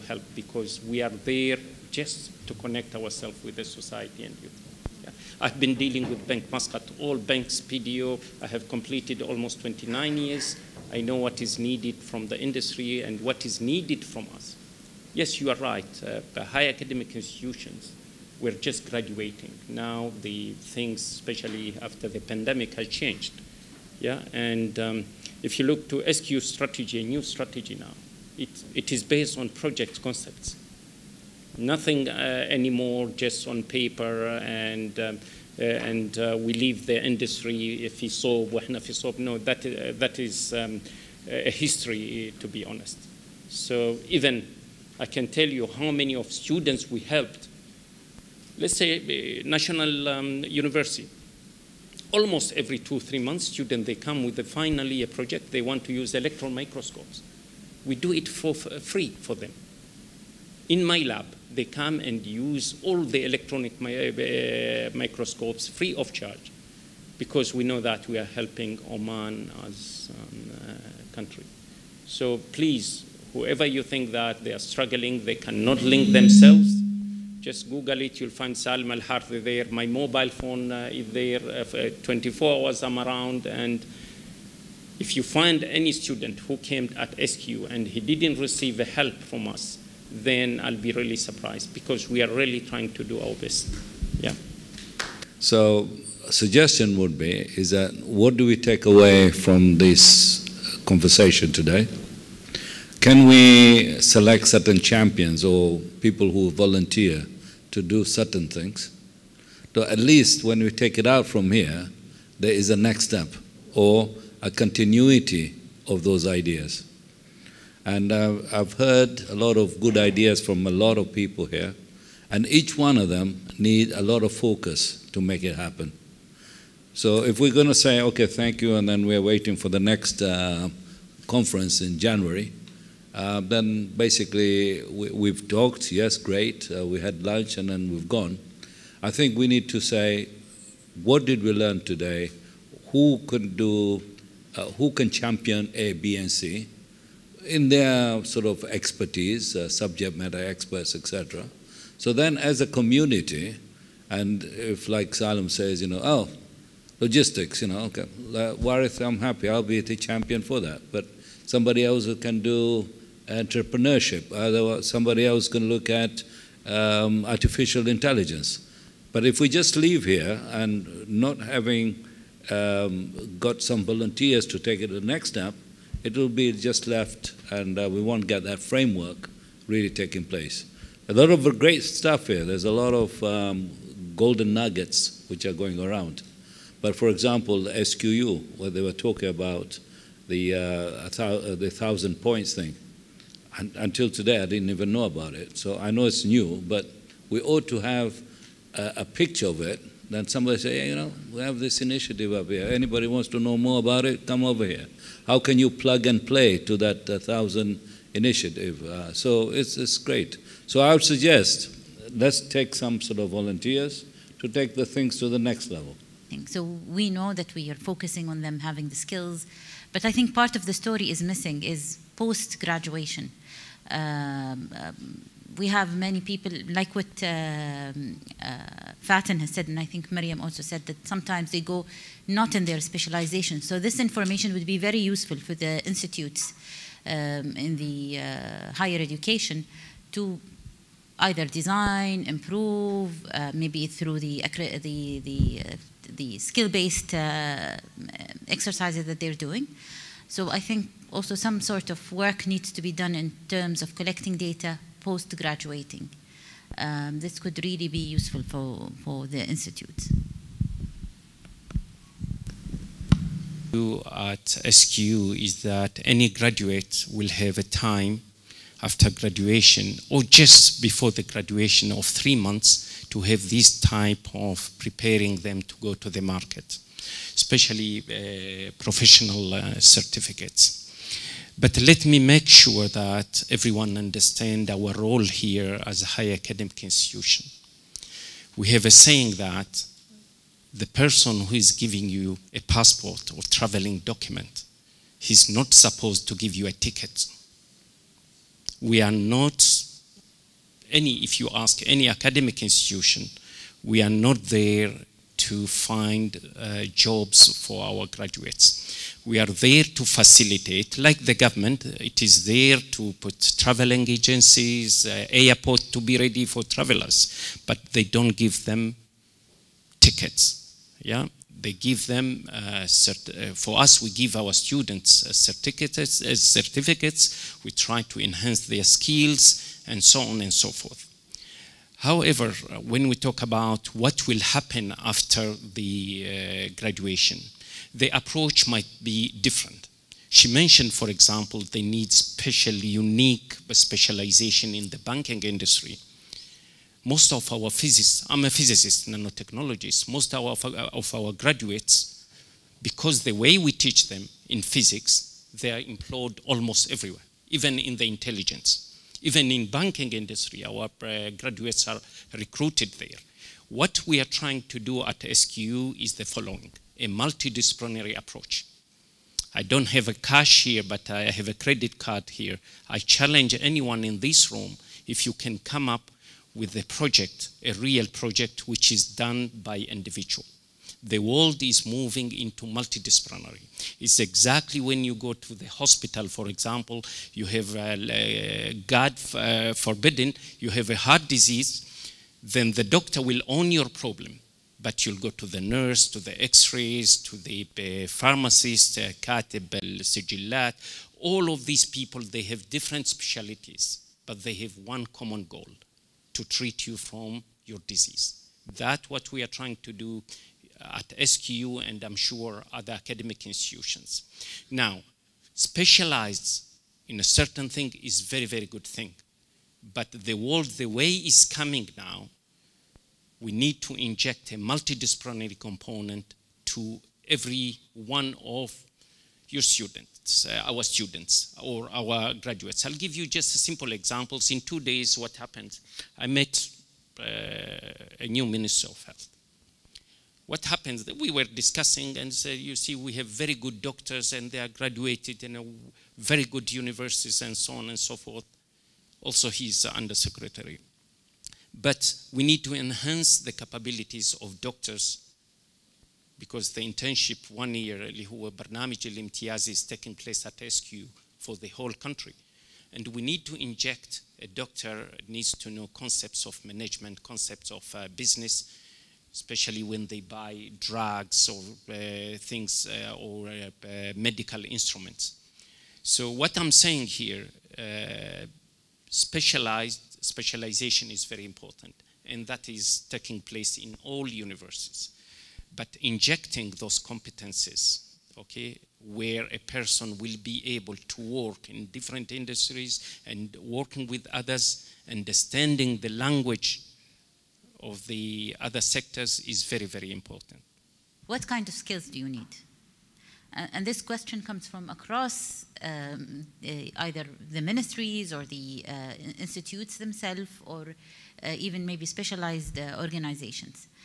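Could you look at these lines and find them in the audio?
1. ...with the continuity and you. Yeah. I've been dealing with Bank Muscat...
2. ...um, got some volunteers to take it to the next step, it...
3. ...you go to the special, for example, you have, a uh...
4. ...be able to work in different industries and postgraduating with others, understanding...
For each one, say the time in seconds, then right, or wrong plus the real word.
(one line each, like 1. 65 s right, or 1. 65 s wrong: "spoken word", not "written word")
1. 3 s wrong: "society", not "continuity"
2. 172 s right
3. 385 s wrong: "hospital", not "special"
4. 490 s wrong: "working", not "postgraduating".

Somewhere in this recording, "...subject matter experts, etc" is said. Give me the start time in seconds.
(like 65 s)
149 s.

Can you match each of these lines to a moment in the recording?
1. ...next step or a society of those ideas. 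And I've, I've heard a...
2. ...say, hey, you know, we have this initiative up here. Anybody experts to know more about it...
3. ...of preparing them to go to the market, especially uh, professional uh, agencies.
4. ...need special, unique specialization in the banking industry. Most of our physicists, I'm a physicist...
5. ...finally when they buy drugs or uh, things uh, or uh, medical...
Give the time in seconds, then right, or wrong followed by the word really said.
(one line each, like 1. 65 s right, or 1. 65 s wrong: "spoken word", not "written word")
1. 112 s wrong: "continuity", not "society"
2. 200 s wrong: "wants", not "experts"
3. 274 s wrong: "certificates", not "agencies"
4. 341 s right
5. 469 s wrong: "especially", not "finally".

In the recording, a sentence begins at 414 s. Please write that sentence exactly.
Now, specialized in a certain thing is very, very good thing.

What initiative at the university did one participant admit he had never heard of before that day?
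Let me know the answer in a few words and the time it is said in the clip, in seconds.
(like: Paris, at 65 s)
The thousand points, at 191 s.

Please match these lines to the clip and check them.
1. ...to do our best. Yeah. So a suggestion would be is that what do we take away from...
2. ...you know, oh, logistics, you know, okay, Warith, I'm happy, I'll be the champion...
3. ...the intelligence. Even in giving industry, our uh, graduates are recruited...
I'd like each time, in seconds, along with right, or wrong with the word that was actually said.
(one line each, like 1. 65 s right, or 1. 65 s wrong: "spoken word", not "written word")
1. 92 s right
2. 155 s right
3. 357 s wrong: "banking", not "giving".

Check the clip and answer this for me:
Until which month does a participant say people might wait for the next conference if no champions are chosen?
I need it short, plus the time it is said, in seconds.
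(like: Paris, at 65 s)
January, at 131 s.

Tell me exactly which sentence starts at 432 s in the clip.
I'll give you just simple examples.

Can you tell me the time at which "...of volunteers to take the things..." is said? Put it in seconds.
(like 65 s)
213 s.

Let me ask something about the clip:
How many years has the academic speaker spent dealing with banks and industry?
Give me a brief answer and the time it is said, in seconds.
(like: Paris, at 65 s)
29 years, at 9 s.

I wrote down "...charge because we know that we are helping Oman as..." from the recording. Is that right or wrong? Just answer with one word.
right.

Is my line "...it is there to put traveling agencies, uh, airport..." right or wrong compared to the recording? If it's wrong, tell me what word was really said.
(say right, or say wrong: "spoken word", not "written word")
right.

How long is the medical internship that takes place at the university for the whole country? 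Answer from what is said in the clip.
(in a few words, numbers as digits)
1 year.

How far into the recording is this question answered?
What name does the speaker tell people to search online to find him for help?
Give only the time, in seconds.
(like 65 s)
78 s.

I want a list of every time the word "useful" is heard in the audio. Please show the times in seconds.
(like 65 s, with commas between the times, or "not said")
234 s, 258 s.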